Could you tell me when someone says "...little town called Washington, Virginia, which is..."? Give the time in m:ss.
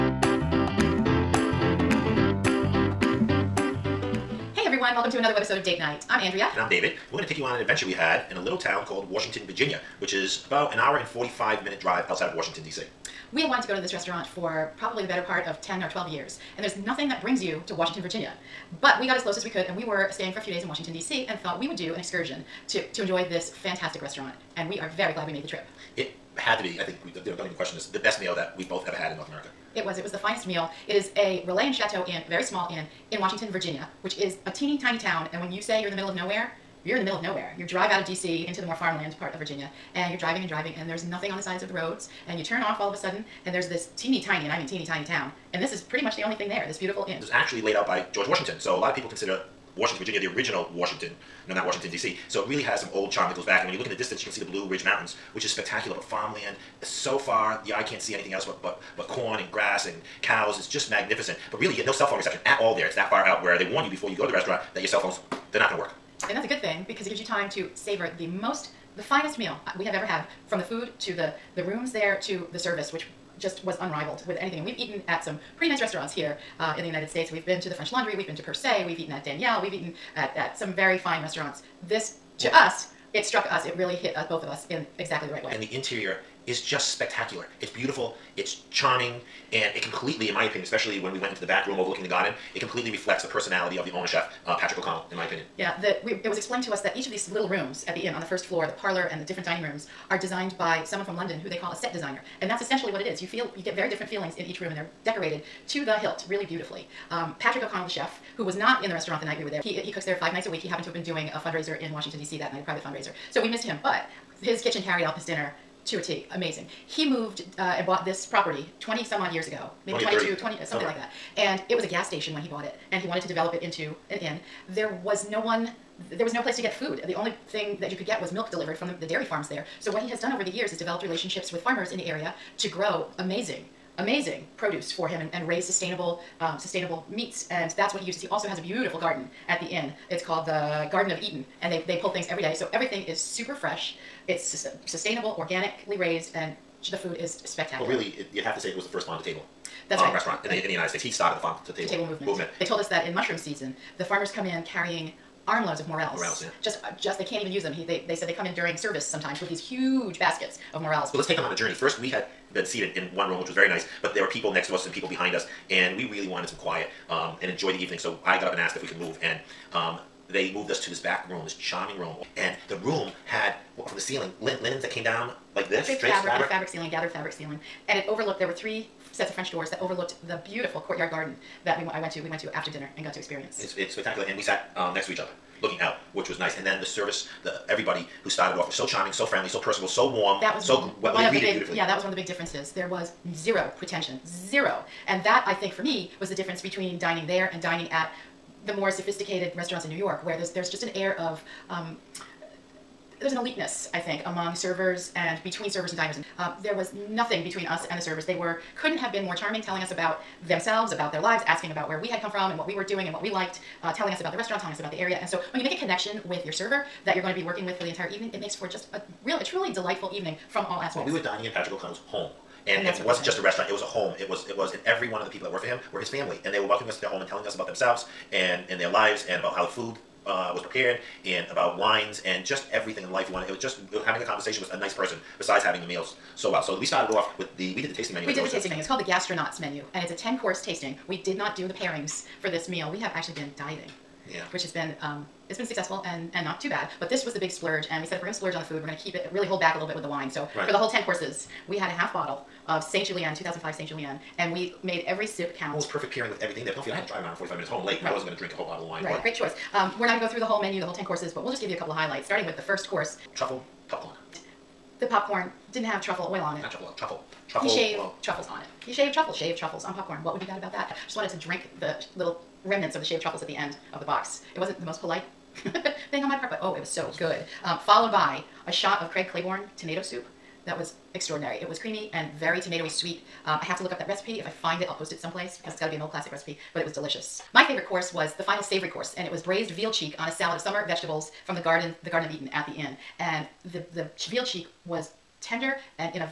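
0:08.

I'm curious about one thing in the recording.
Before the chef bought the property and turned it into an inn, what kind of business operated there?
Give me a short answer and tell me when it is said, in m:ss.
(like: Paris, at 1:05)
A gas station, at 2:01.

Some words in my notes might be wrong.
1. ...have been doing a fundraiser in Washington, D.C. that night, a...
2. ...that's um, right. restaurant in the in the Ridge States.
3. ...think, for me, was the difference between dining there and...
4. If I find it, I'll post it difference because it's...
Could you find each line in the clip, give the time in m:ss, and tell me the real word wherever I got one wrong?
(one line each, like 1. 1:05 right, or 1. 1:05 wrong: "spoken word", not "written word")
1. 1:50 right
2. 2:29 wrong: "United", not "Ridge"
3. 3:15 right
4. 4:44 wrong: "someplace", not "difference".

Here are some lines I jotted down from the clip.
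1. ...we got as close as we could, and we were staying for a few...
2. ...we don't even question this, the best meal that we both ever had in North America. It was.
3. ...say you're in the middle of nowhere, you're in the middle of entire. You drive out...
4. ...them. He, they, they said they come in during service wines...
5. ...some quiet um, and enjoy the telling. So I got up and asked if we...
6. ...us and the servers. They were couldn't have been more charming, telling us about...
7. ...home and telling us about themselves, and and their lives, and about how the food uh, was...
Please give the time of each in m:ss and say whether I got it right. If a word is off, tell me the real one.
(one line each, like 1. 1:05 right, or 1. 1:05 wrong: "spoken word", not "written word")
1. 0:19 right
2. 0:27 right
3. 0:35 wrong: "nowhere", not "entire"
4. 2:37 wrong: "sometimes", not "wines"
5. 2:46 wrong: "evening", not "telling"
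6. 3:27 right
7. 3:47 right.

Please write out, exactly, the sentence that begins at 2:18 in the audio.
He also has a beautiful garden at the inn.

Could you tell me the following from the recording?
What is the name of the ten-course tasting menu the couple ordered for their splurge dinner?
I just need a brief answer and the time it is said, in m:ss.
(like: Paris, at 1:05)
Gastronauts menu, at 3:59.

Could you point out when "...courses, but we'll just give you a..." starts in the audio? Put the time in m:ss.
4:21.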